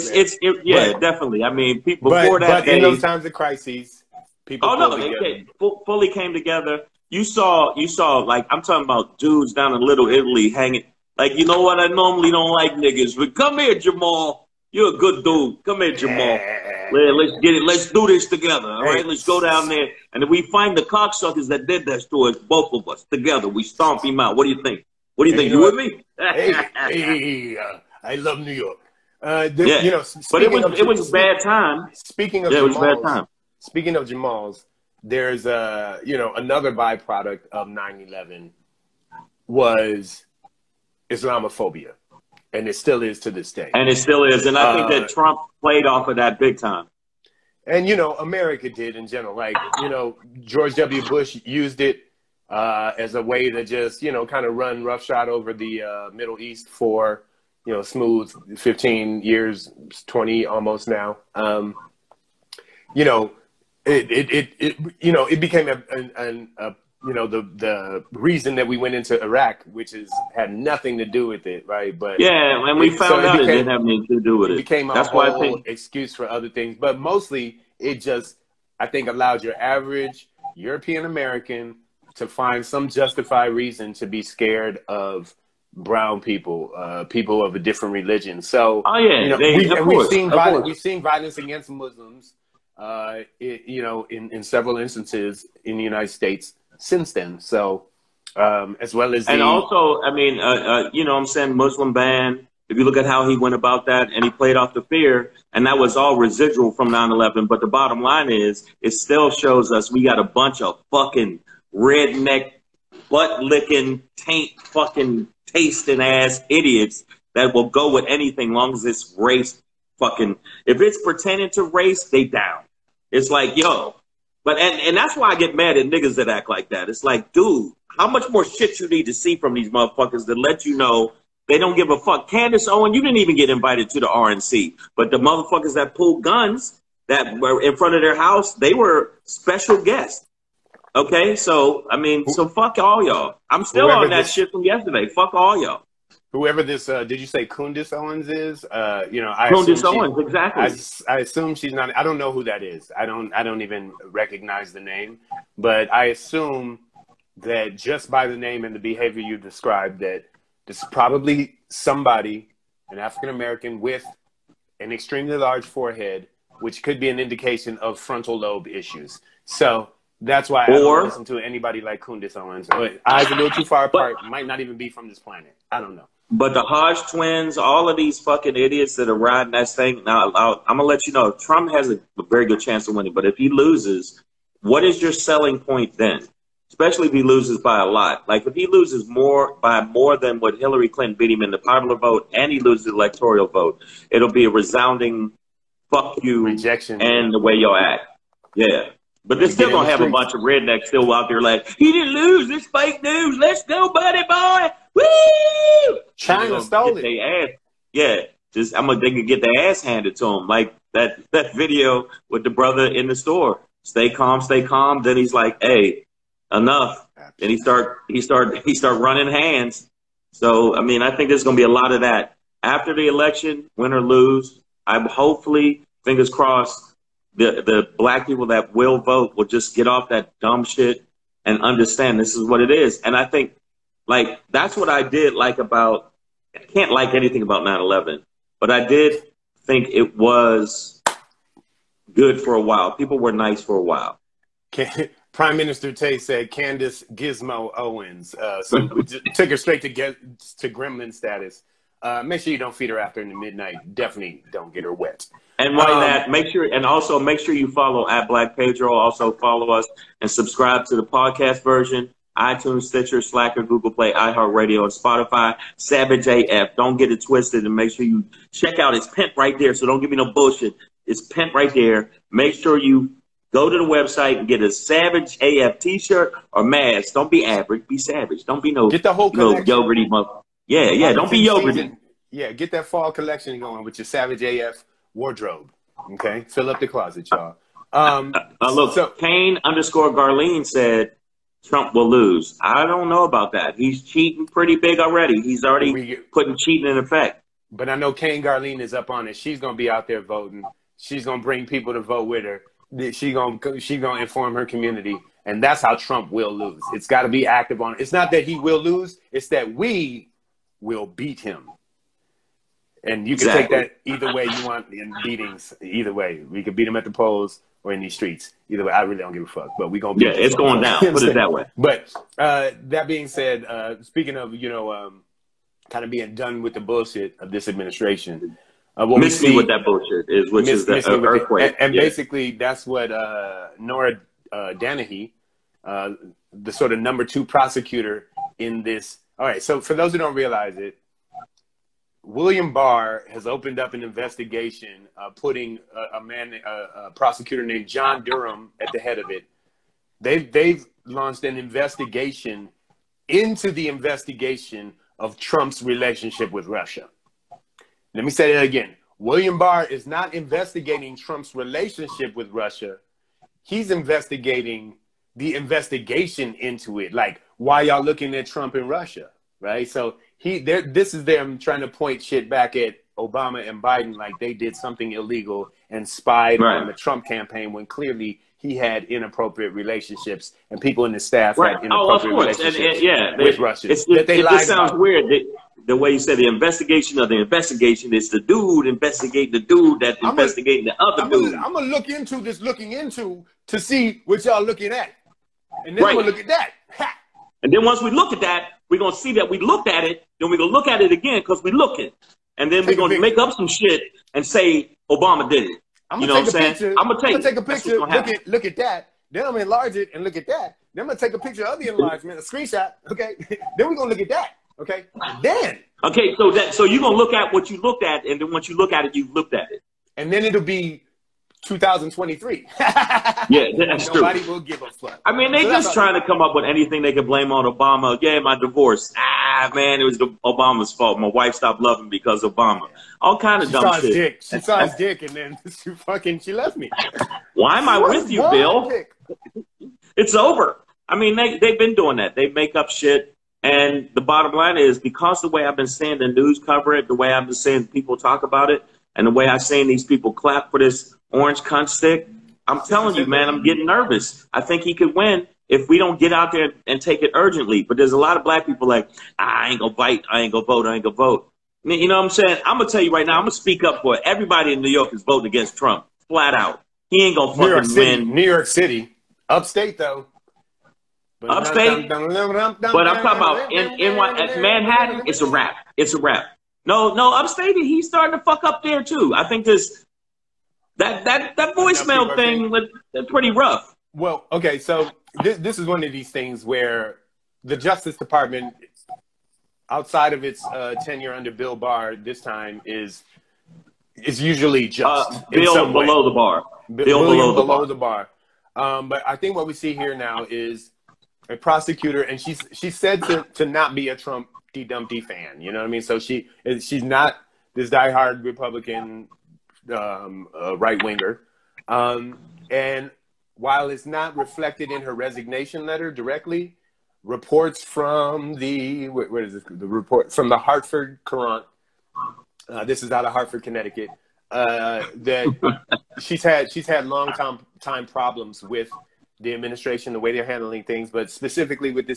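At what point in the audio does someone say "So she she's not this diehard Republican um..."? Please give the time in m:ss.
8:26.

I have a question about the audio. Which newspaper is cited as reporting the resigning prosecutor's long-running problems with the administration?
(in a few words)
Hartford Courant.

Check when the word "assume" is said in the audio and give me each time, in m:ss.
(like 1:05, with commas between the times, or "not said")
2:31, 2:36.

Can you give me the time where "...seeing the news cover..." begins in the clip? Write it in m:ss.
7:25.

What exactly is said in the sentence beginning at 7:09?
Ah, man, it was Obama's fault.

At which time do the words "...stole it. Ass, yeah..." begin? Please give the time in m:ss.
3:26.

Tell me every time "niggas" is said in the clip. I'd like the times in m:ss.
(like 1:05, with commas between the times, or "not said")
0:12, 2:05.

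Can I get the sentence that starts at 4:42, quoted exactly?
Yeah, get that fall collection going with your Savage AF wardrobe.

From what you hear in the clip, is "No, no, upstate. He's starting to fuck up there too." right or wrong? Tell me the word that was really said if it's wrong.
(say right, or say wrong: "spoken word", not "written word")
right.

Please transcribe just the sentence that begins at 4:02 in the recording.
People were nice for a while.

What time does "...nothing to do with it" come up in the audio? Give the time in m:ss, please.
1:10.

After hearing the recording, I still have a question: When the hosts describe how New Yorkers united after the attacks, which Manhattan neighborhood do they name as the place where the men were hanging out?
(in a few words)
Little Italy.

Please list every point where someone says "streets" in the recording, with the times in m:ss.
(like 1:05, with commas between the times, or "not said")
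3:19, 5:18.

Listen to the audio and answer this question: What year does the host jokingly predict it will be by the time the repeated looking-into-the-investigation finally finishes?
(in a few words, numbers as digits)
2023.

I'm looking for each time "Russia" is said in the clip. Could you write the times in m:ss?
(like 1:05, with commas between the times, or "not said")
5:56, 6:02, 6:08, 6:23.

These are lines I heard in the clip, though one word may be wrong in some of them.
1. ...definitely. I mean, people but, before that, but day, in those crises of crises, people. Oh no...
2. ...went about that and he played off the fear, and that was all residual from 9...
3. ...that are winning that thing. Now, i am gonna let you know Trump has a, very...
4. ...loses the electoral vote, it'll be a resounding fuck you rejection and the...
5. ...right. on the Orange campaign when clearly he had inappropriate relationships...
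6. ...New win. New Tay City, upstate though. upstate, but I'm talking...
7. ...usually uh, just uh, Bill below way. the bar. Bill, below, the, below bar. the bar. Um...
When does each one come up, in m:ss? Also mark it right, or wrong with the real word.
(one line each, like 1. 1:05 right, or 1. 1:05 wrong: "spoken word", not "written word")
1. 0:01 wrong: "times", not "crises"
2. 1:43 right
3. 2:58 wrong: "riding", not "winning"
4. 3:12 right
5. 6:16 wrong: "Trump", not "Orange"
6. 7:47 wrong: "York", not "Tay"
7. 8:14 right.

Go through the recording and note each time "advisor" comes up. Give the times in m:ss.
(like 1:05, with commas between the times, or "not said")
not said.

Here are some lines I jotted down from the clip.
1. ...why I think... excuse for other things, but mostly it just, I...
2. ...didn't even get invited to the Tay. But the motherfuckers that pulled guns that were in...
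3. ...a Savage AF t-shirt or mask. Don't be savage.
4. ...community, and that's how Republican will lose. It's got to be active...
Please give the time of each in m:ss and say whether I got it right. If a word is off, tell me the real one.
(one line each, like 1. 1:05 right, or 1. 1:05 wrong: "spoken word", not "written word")
1. 1:15 right
2. 2:13 wrong: "RNC", not "Tay"
3. 4:34 wrong: "average", not "savage"
4. 5:04 wrong: "Trump", not "Republican".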